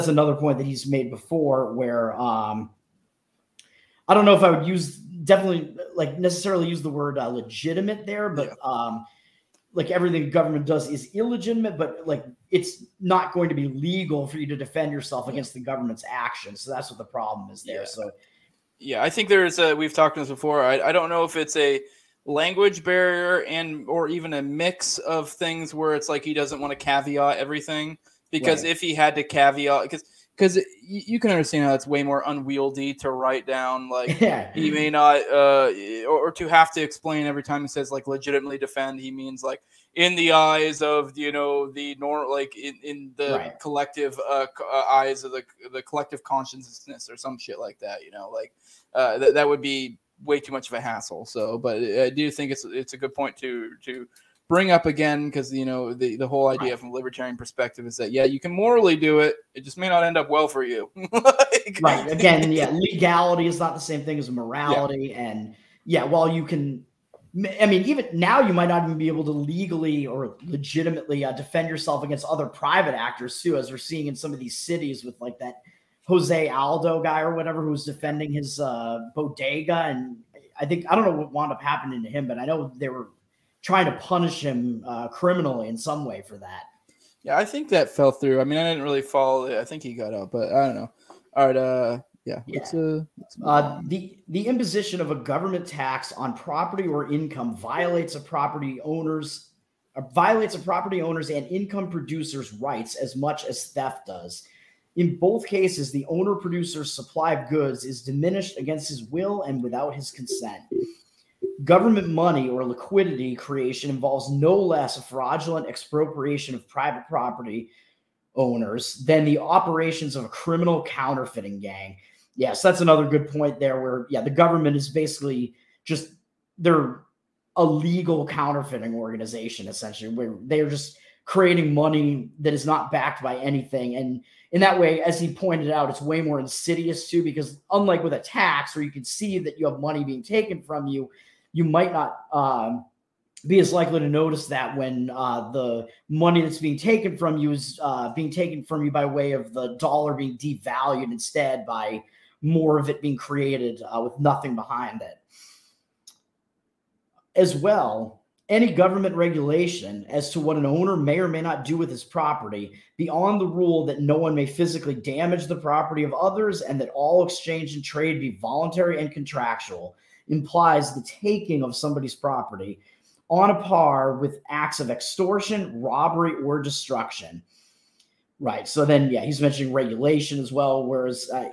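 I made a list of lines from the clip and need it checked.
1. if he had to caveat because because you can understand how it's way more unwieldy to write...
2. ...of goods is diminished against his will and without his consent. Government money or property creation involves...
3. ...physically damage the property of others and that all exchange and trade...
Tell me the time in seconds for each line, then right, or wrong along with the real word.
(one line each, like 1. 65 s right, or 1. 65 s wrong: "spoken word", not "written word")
1. 28 s right
2. 107 s wrong: "liquidity", not "property"
3. 164 s right.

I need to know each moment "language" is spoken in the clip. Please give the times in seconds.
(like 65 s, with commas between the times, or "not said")
22 s.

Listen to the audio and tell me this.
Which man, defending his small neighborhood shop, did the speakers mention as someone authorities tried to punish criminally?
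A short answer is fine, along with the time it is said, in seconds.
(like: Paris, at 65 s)
Jose Aldo, at 76 s.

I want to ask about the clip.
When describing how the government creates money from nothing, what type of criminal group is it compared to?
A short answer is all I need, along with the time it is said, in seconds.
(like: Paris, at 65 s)
counterfeiting gang, at 120 s.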